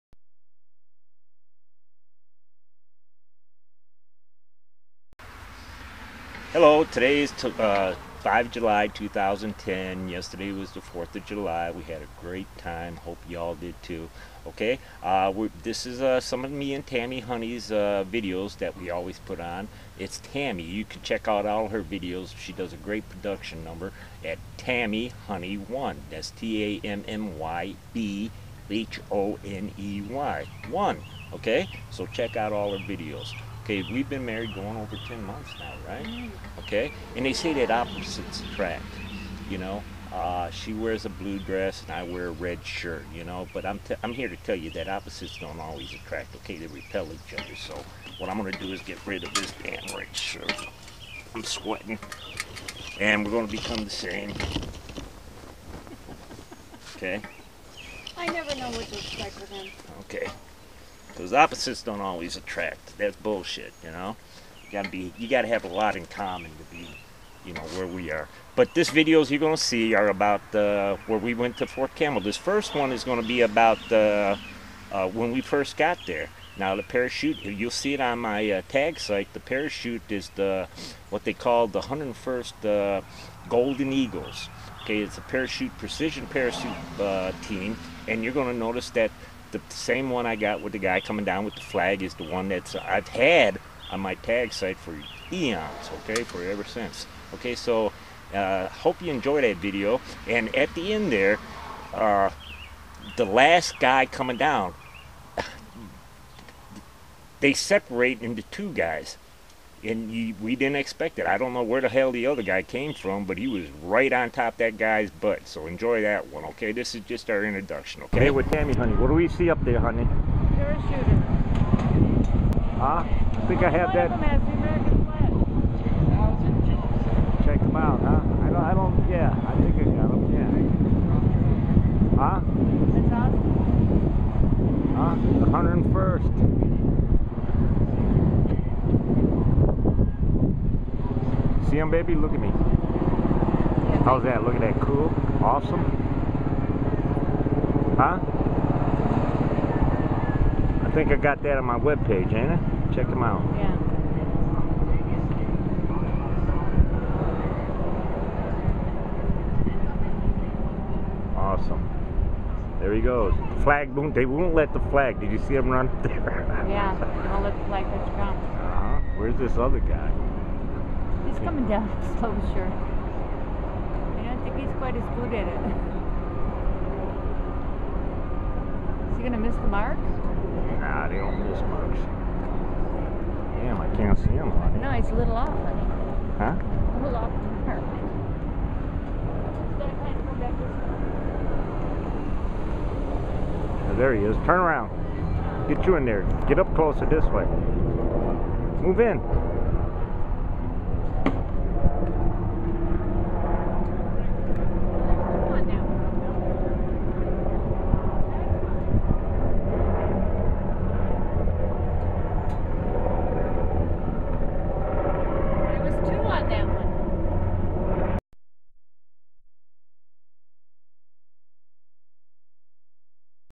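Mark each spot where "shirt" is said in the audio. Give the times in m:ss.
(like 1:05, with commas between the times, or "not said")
0:42, 0:50.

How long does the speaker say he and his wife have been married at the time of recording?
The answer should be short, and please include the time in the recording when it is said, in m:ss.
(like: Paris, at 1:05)
over 10 months, at 0:34.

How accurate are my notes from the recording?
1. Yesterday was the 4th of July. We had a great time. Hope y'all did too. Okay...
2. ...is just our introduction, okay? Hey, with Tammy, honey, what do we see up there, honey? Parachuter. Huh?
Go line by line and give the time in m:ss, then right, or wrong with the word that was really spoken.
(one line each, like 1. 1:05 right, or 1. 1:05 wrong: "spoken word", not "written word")
1. 0:10 right
2. 1:56 right.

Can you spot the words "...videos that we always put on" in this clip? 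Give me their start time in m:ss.
0:18.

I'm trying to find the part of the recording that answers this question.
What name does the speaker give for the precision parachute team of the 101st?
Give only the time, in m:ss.
1:23.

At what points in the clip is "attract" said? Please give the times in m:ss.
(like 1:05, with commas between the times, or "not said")
0:38, 0:45, 1:02.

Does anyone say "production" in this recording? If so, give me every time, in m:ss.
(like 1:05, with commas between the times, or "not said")
0:23.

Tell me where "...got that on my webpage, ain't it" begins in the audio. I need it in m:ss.
2:31.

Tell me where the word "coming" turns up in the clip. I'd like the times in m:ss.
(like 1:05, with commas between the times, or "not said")
1:30, 1:44, 2:51.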